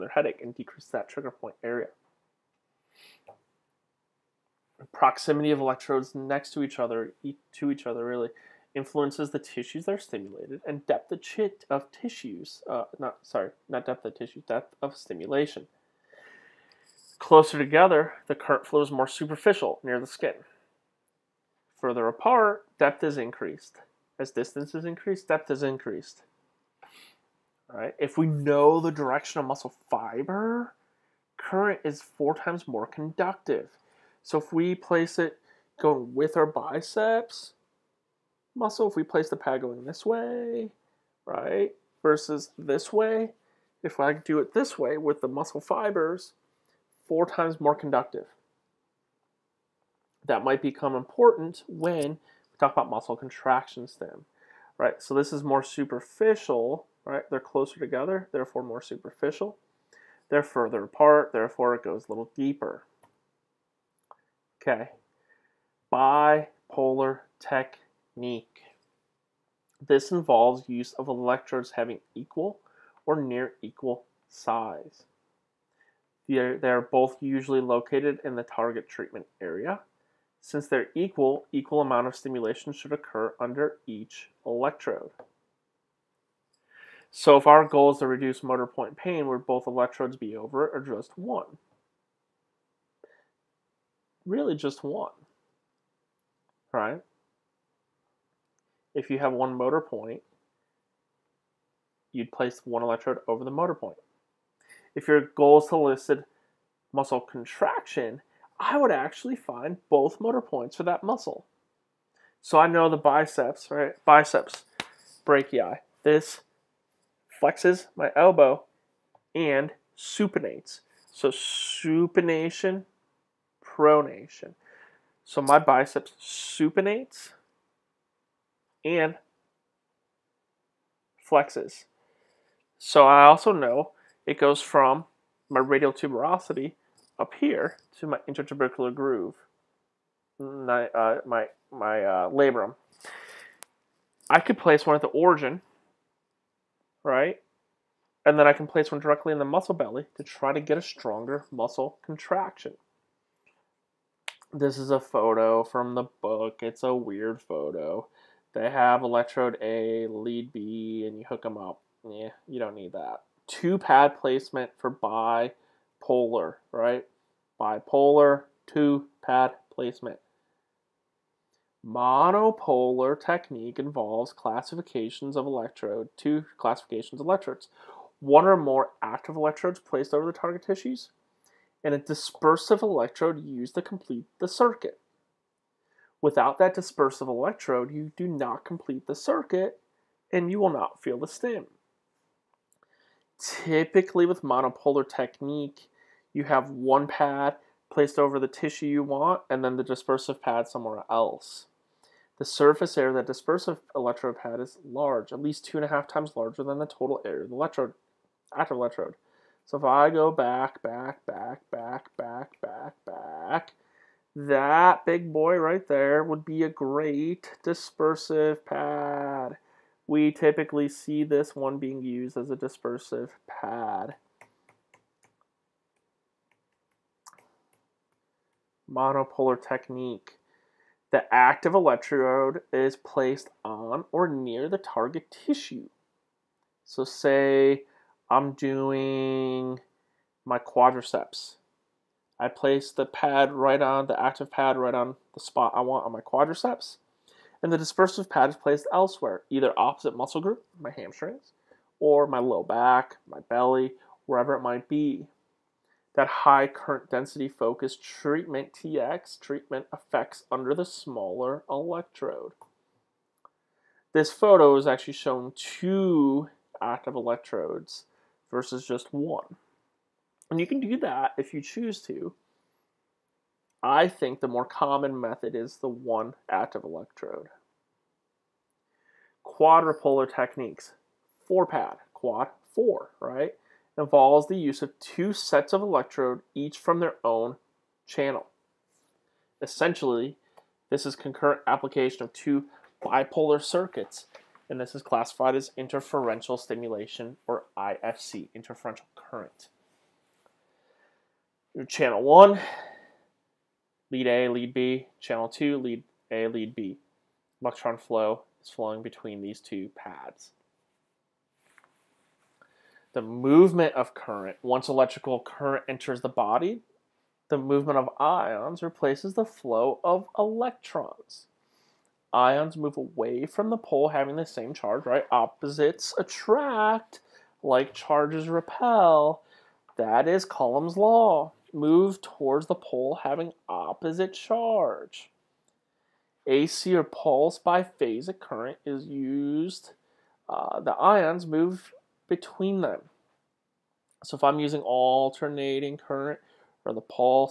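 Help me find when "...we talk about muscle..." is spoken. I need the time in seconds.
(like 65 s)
52 s.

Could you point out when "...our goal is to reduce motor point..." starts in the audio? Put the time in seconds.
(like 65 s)
87 s.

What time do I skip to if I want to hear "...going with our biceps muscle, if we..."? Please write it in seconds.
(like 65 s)
35 s.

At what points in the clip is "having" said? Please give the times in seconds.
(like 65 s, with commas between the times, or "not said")
71 s, 324 s, 333 s.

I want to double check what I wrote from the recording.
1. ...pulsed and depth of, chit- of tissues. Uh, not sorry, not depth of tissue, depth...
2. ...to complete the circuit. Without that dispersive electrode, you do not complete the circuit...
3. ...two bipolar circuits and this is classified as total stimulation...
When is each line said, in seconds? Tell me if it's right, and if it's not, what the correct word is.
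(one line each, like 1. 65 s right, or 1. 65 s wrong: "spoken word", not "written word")
1. 9 s wrong: "stimulated", not "pulsed"
2. 183 s right
3. 292 s wrong: "interferential", not "total".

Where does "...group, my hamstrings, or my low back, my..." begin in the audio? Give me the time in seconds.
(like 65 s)
250 s.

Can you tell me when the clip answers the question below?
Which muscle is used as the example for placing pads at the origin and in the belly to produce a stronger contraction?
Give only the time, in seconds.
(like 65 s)
114 s.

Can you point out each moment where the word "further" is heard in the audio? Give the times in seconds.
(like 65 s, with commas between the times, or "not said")
21 s, 60 s.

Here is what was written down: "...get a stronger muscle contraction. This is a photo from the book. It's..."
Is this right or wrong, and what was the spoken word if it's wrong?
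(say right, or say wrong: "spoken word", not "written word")
right.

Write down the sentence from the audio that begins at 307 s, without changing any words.
Electron flow is flowing between these two pads.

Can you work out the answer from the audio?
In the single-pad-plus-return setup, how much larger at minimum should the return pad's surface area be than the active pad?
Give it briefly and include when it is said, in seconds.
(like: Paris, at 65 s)
2.5 times, at 205 s.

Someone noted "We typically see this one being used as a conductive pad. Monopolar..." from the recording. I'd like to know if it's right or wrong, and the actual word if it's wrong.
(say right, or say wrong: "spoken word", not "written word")
wrong: "dispersive", not "conductive".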